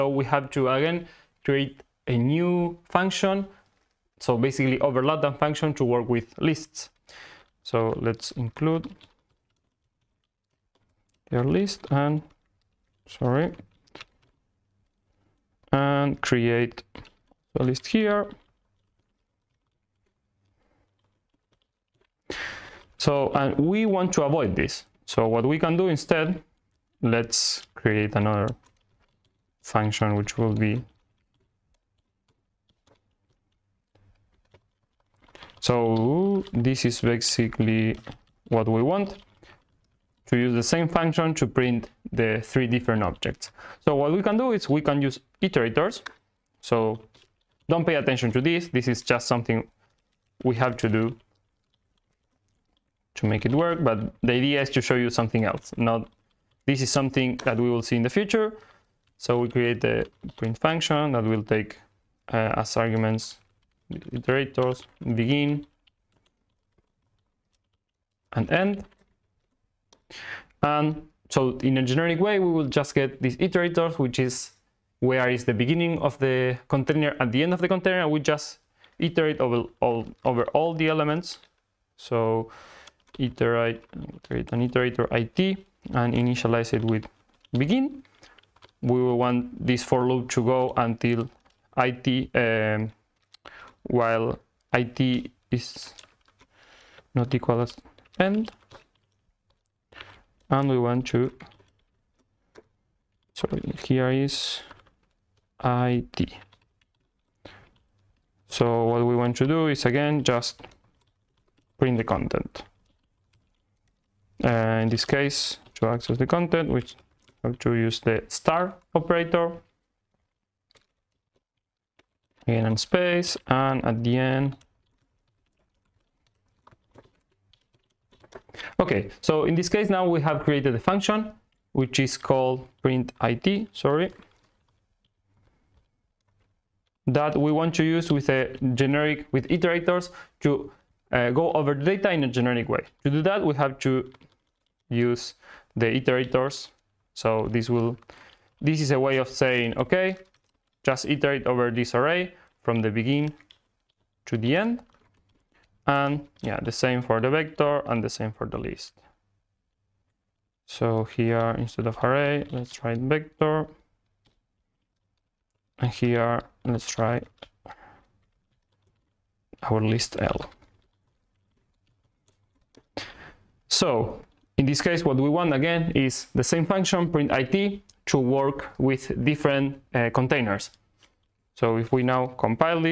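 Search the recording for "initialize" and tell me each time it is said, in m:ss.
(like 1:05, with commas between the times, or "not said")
1:26.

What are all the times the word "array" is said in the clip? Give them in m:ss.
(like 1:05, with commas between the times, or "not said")
2:31, 2:42.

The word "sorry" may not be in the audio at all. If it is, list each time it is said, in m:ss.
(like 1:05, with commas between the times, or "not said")
0:13, 1:43, 2:13.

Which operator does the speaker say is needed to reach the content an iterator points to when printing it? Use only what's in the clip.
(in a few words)
star operator.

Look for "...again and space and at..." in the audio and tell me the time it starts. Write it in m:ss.
2:02.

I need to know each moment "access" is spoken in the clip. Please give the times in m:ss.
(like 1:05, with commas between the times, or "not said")
1:55.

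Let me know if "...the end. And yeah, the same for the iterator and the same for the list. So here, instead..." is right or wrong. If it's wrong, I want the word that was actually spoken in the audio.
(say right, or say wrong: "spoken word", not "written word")
wrong: "vector", not "iterator".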